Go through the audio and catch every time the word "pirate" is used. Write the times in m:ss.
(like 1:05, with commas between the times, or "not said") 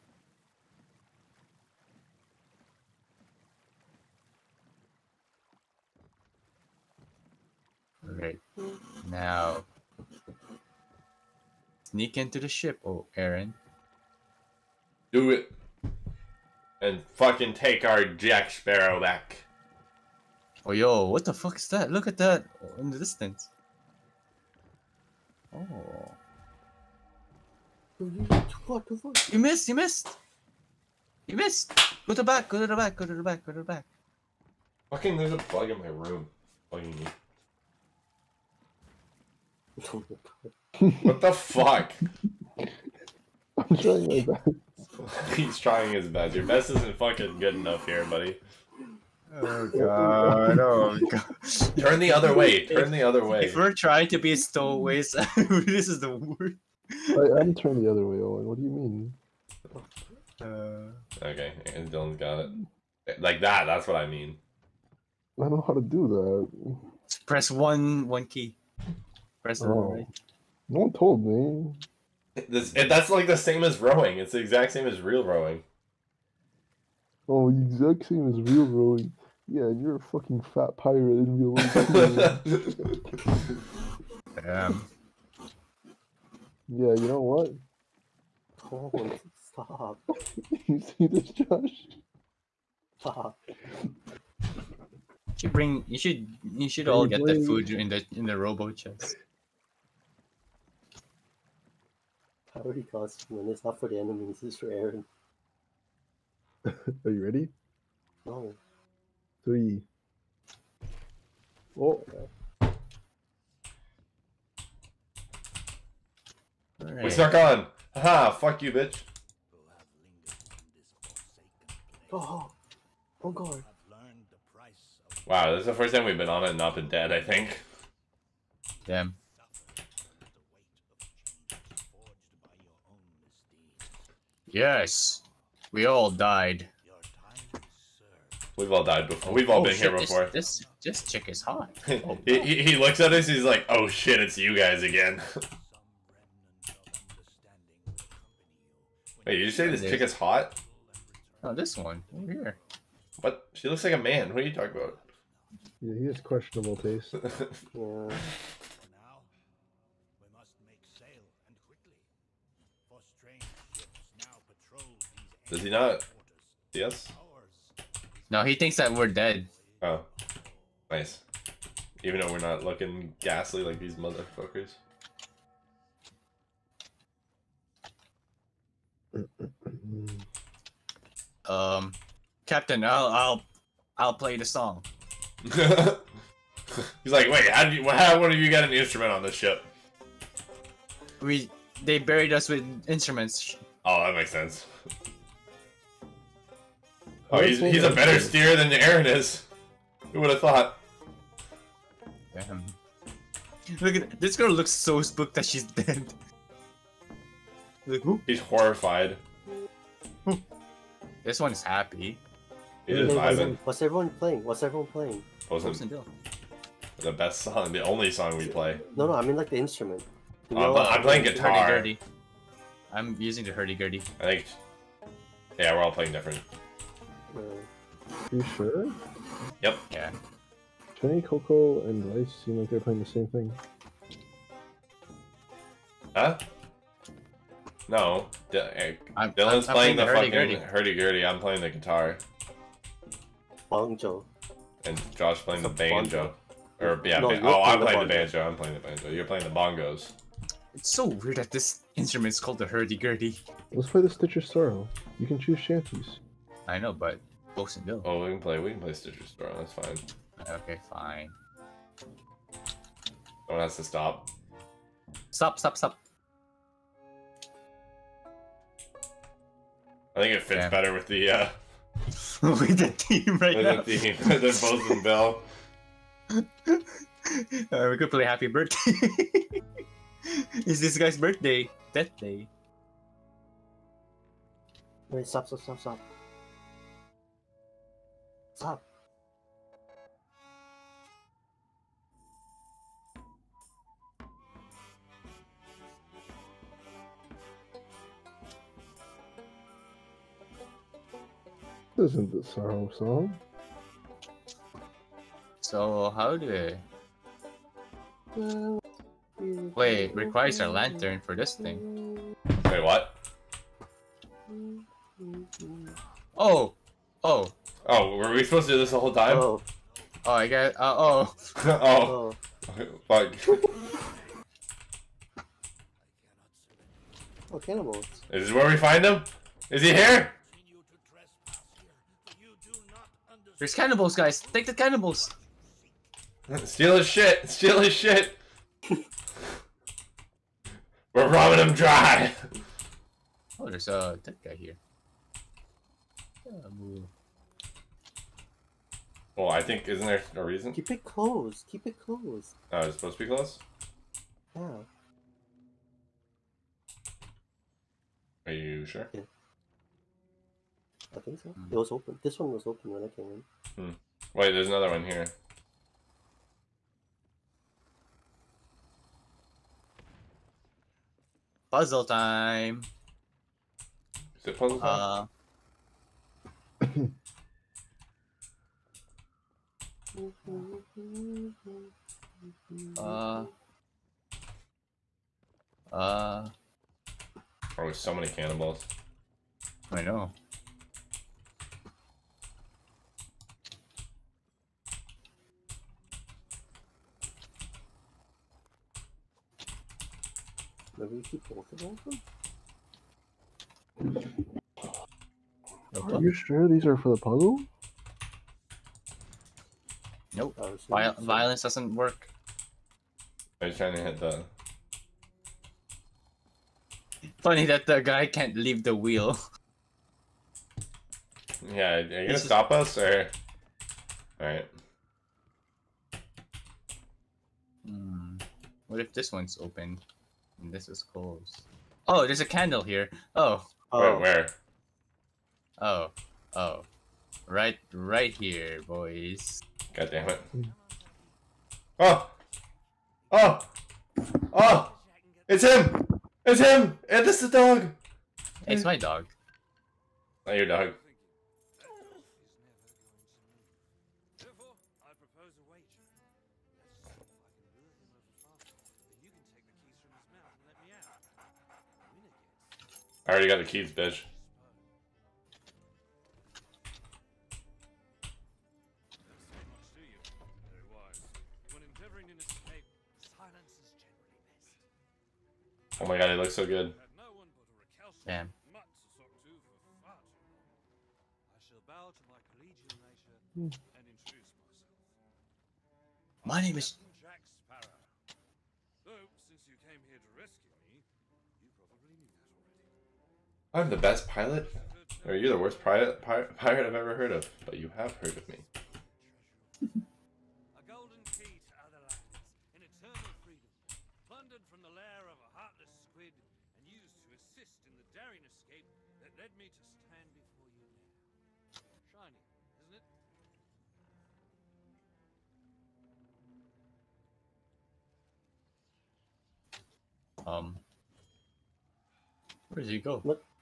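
1:20.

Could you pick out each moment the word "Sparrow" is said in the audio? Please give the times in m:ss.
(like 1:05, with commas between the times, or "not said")
0:18.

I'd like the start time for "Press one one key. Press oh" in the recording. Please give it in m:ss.
1:07.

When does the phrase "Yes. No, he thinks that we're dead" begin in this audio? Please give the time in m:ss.
2:46.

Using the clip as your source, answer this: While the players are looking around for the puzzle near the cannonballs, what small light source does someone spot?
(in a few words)
a candle.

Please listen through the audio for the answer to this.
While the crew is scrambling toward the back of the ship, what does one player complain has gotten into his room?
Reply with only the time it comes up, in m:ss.
0:35.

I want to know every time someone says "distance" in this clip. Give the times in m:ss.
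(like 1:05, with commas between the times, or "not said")
0:22.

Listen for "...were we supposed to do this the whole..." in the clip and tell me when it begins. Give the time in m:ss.
5:18.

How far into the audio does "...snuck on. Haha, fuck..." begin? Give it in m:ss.
1:57.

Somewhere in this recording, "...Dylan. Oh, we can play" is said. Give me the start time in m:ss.
4:17.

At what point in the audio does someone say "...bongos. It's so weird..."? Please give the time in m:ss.
4:09.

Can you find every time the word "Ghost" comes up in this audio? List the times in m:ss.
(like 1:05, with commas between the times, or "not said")
4:17.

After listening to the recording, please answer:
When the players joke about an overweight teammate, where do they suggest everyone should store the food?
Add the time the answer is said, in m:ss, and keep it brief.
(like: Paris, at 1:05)
robo chest, at 1:38.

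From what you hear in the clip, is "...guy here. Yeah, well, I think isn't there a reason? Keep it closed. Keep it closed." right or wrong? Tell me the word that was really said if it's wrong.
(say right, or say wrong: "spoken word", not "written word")
right.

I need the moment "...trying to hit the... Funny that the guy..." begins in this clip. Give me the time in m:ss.
6:53.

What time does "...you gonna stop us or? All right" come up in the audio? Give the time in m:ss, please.
7:02.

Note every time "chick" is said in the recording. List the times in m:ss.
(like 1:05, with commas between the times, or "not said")
2:21, 2:29.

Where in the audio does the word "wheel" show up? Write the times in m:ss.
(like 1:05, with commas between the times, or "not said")
6:58.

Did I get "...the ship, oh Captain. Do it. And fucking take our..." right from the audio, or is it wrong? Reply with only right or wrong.
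wrong.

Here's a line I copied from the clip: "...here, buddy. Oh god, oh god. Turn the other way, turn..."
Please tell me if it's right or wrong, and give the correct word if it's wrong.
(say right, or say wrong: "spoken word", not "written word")
right.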